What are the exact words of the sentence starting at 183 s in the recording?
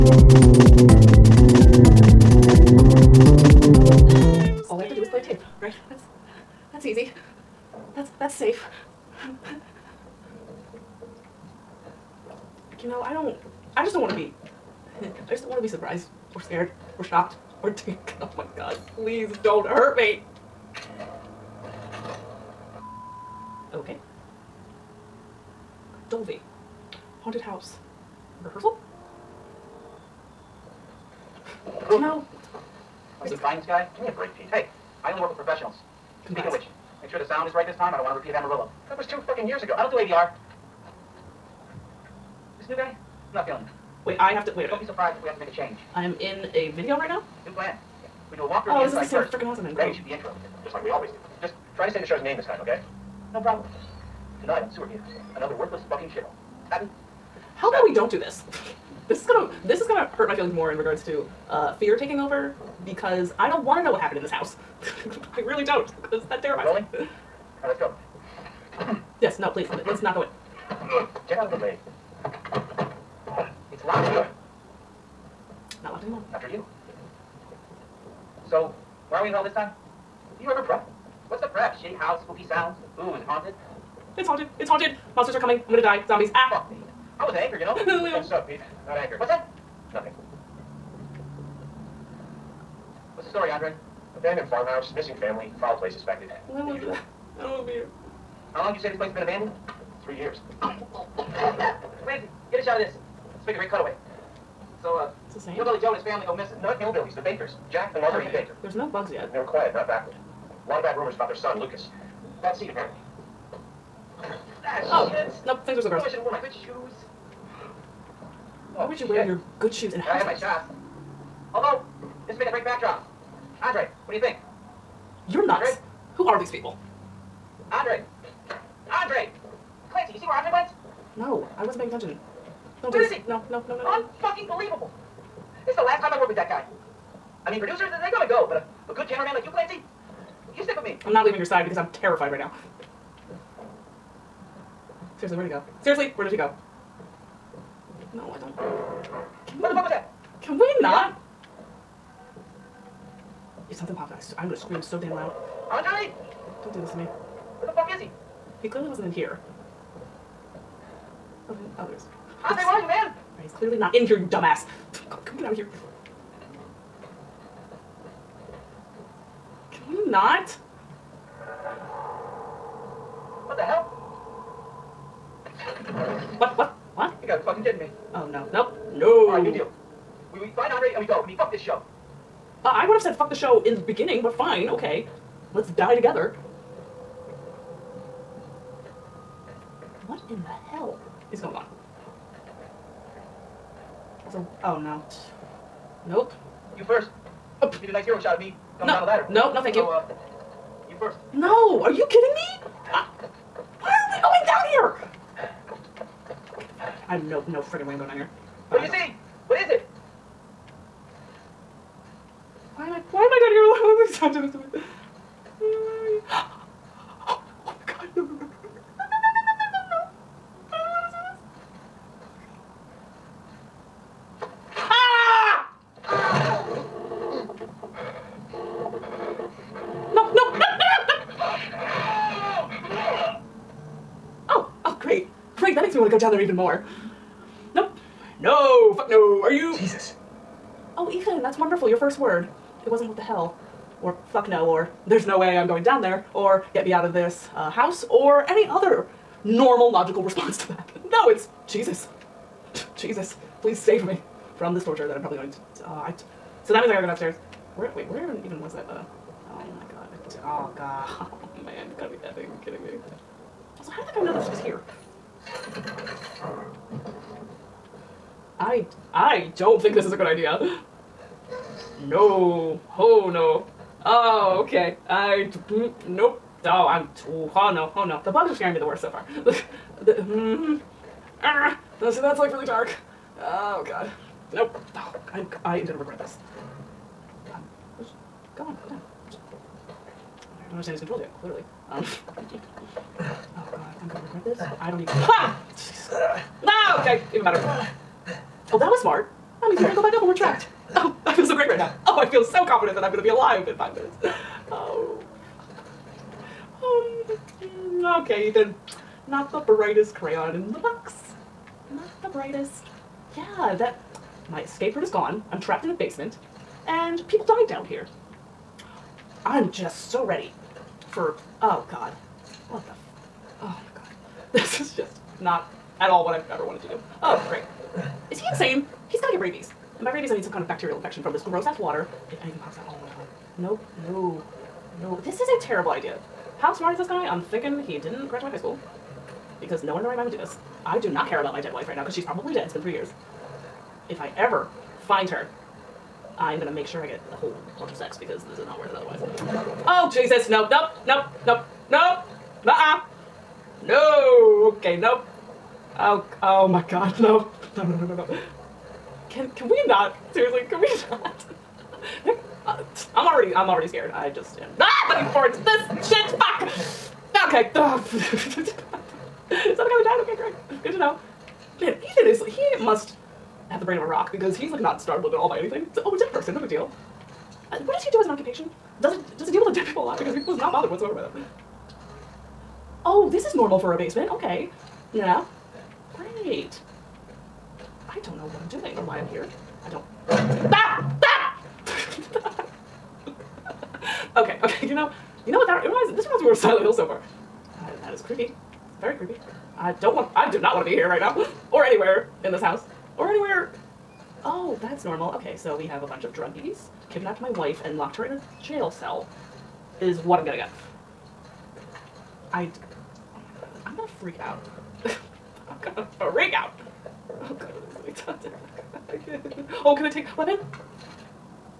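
fuck the show in the beginning, but fine, okay.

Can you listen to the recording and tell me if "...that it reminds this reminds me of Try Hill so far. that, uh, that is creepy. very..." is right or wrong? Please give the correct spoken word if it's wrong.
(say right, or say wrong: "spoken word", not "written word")
wrong: "Silent", not "Try".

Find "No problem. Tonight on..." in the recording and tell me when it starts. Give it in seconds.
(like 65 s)
53 s.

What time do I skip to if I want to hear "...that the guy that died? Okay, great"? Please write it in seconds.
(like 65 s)
369 s.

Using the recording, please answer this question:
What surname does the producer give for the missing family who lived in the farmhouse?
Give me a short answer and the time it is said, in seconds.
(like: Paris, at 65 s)
Baker, at 107 s.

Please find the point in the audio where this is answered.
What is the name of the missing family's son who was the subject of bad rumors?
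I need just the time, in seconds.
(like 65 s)
111 s.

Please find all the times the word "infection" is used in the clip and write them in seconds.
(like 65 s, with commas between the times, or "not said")
330 s.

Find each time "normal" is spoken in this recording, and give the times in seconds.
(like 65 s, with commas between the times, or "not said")
249 s, 383 s, 405 s.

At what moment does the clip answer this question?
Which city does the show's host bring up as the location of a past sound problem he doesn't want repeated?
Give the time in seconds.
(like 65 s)
38 s.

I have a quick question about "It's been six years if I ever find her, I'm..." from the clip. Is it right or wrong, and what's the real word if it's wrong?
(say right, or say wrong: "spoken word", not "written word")
wrong: "three", not "six".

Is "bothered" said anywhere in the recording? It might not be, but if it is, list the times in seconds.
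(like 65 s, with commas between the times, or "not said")
380 s.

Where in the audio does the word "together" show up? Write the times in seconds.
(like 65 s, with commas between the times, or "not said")
185 s.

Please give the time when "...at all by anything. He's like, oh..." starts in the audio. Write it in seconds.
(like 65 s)
375 s.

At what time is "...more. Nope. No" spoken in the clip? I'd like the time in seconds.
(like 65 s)
236 s.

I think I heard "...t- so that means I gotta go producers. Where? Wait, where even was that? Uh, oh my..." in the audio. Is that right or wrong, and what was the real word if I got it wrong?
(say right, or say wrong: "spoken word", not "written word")
wrong: "downstairs", not "producers".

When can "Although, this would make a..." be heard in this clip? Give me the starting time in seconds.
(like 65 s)
121 s.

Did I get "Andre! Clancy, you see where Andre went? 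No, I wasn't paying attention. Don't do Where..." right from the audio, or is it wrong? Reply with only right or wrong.
right.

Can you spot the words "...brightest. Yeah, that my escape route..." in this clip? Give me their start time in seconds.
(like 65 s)
312 s.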